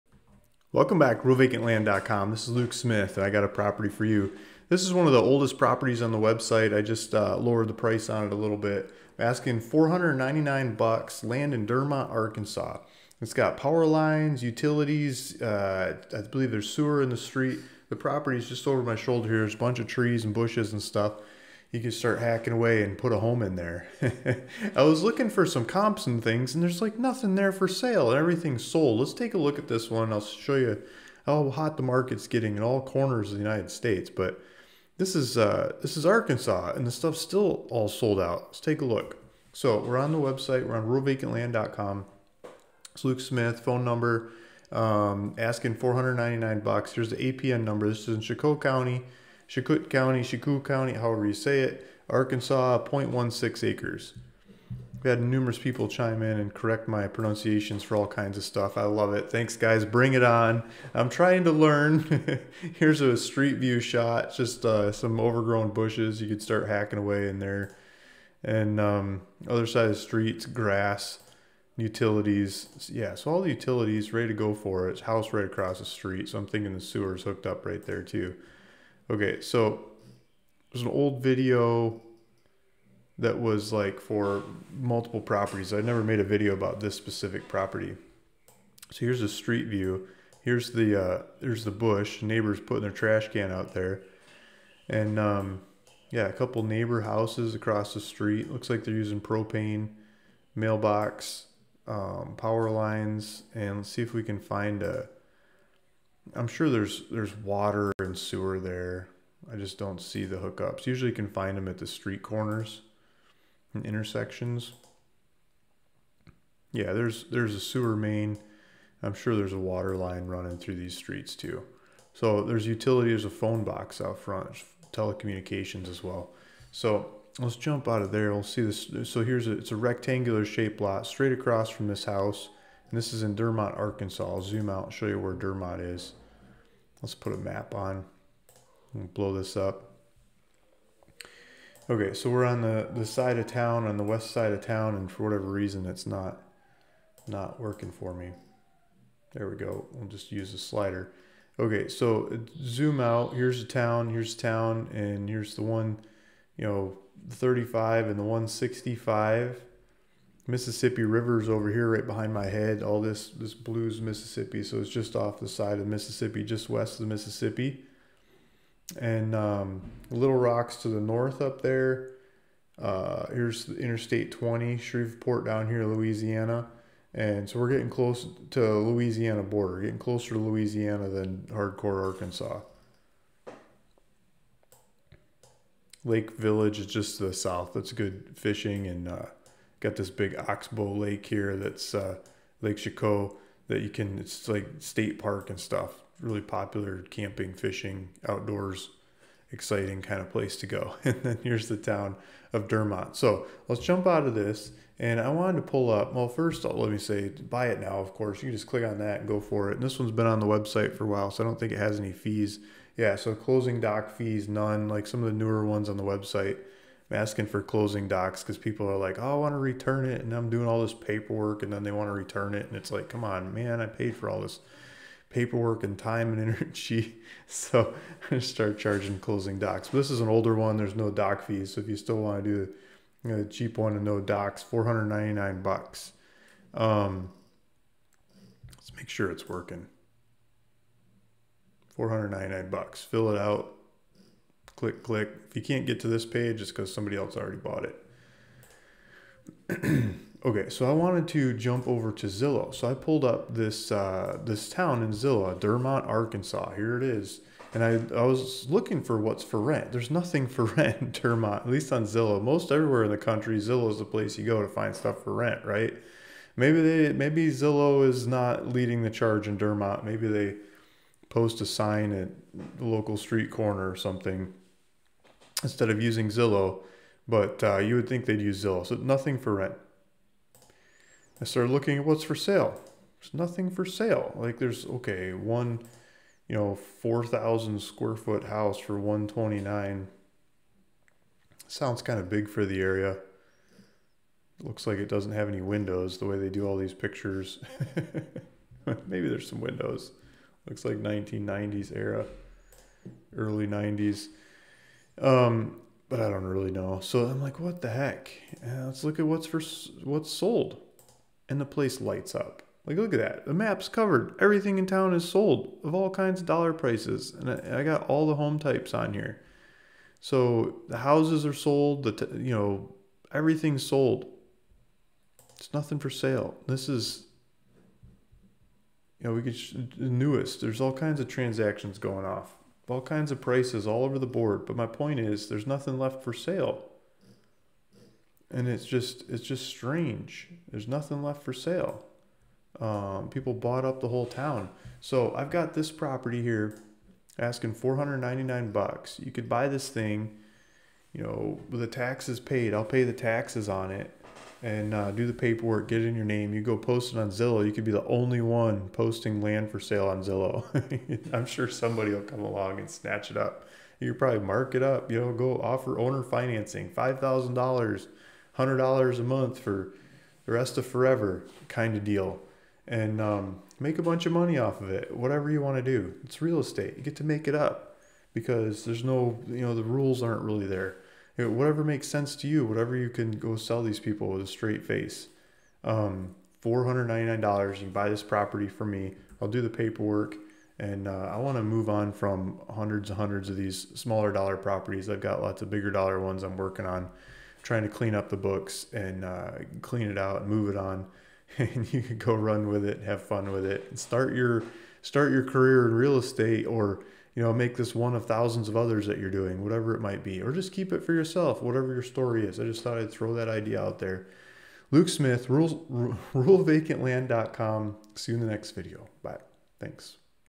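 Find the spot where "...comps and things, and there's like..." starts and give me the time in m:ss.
0:25.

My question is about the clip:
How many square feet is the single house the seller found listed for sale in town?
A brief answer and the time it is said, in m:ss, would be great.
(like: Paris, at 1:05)
4,000, at 4:46.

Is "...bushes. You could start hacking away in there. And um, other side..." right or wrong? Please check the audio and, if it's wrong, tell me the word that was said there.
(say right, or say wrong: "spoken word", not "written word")
right.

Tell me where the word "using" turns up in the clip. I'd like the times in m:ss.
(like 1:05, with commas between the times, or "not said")
1:38, 4:36.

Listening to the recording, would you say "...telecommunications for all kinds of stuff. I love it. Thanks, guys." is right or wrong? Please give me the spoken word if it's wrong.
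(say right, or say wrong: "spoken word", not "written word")
wrong: "pronunciations", not "telecommunications".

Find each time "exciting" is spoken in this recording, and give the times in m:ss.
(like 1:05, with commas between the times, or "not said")
3:19.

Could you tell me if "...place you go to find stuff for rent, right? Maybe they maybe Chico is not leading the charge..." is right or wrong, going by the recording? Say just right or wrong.
wrong.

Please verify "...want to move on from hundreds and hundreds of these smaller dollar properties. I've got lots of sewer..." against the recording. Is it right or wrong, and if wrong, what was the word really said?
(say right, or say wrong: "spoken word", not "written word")
wrong: "bigger", not "sewer".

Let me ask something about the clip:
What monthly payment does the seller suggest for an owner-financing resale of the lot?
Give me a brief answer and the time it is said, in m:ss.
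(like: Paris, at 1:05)
$100, at 6:08.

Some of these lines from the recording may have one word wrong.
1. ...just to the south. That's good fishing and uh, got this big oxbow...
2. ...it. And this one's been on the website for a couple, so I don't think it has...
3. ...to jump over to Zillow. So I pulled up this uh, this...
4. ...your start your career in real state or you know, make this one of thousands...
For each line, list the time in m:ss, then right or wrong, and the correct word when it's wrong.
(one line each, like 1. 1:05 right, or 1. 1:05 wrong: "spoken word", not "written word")
1. 3:06 right
2. 3:29 wrong: "while", not "couple"
3. 4:11 right
4. 6:44 wrong: "estate", not "state".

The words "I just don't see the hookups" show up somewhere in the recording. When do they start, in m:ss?
1:49.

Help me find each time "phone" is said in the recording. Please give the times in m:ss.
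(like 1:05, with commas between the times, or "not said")
0:43, 2:03.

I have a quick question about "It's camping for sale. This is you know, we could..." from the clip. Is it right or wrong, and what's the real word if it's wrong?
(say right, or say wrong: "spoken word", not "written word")
wrong: "nothing", not "camping".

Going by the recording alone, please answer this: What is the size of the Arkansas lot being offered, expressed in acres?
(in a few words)
0.16 acres.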